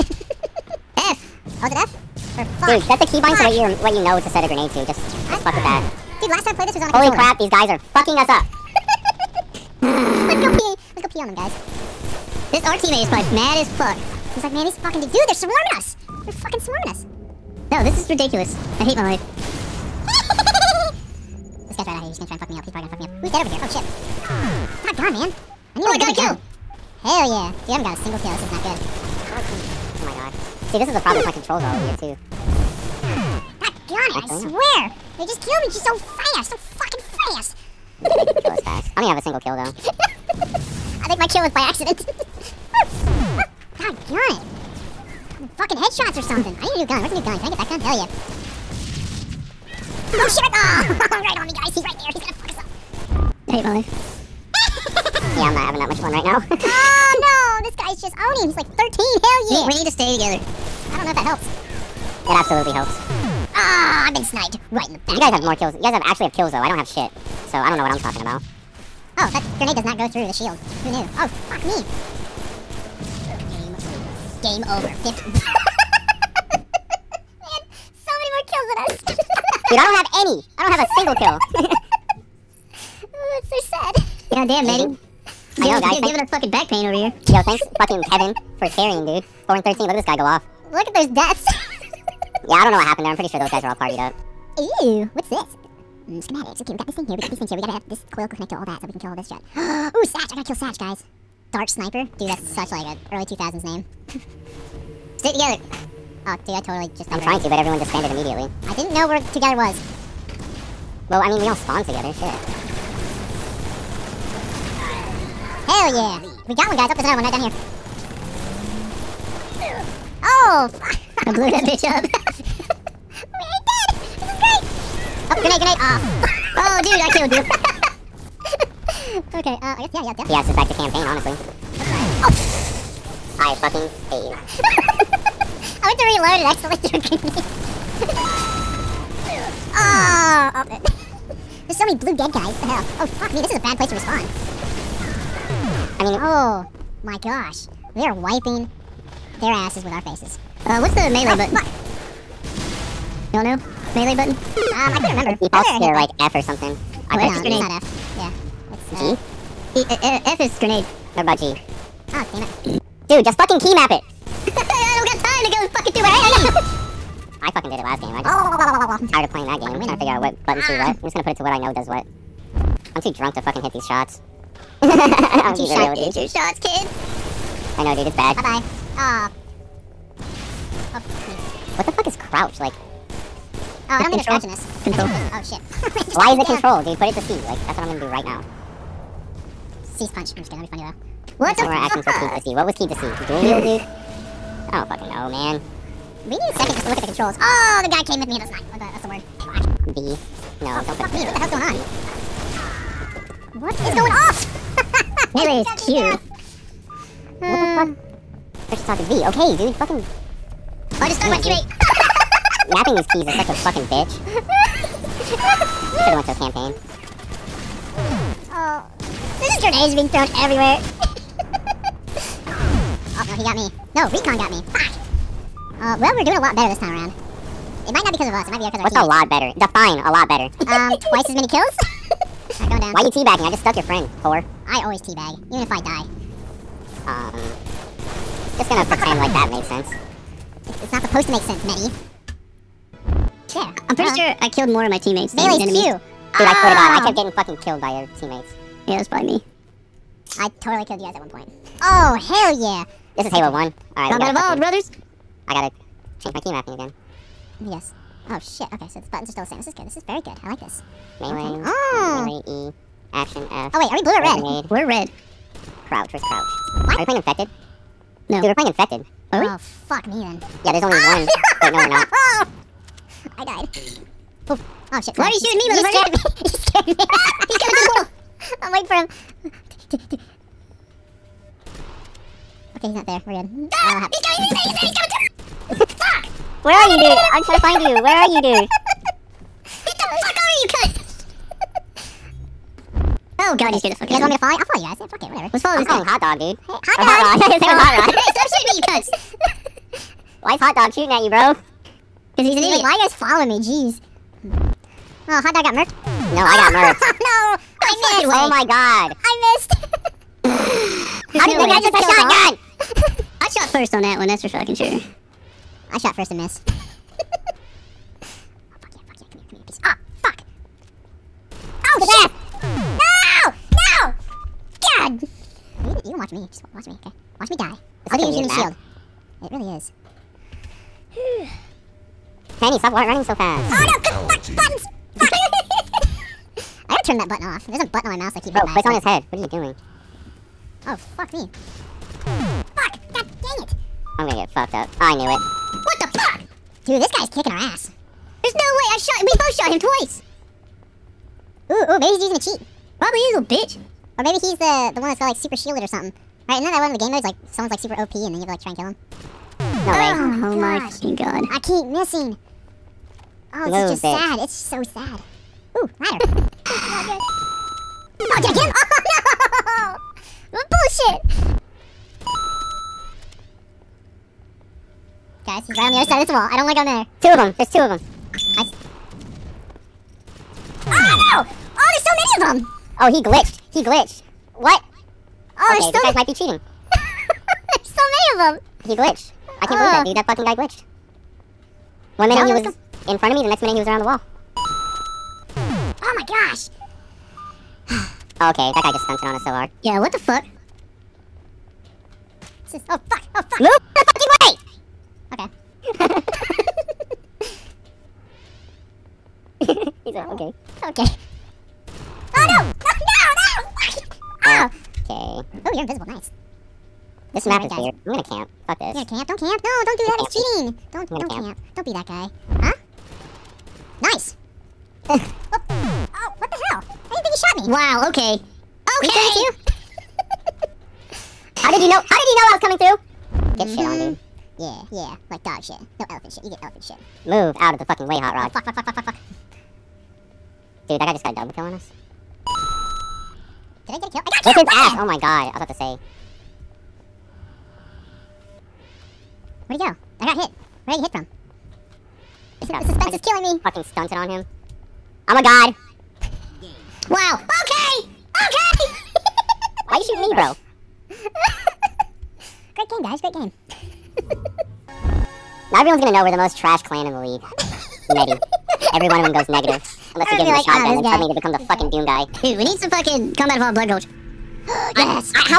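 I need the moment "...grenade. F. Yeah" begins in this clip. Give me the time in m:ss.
2:37.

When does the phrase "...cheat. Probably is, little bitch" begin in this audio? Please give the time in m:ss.
5:52.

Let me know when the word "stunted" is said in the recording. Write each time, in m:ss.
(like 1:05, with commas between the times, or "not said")
6:39, 7:33.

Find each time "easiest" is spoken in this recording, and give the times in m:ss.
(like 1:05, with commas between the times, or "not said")
not said.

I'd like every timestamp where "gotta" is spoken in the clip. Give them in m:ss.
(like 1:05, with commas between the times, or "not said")
1:40, 4:15, 5:36.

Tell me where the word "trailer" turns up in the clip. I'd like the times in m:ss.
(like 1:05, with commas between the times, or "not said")
not said.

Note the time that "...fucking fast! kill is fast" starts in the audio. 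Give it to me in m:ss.
0:36.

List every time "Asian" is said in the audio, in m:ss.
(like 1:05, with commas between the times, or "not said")
not said.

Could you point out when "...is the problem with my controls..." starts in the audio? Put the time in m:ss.
0:30.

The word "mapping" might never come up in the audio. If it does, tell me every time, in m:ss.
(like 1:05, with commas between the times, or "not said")
3:32, 4:16.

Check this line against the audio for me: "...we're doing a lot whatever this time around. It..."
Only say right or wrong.
wrong.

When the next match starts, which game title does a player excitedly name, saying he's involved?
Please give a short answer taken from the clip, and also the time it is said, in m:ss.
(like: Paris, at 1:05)
Halo 1, at 4:13.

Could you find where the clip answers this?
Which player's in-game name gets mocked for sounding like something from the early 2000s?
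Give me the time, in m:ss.
1:41.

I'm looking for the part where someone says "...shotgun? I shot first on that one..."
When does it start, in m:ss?
5:11.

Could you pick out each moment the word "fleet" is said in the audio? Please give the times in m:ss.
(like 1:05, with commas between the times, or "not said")
not said.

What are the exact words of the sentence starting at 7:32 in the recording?
This the suspense is killing me.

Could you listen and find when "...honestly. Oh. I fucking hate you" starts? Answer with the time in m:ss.
2:11.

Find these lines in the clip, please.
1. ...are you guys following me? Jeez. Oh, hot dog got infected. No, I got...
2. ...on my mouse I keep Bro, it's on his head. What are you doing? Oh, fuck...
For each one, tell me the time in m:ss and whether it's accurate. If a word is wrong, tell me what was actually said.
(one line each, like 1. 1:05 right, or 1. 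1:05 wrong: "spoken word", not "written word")
1. 5:02 wrong: "murked", not "infected"
2. 5:38 right.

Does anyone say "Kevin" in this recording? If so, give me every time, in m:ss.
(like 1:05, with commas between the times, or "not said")
1:28.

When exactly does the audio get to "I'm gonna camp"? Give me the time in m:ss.
6:58.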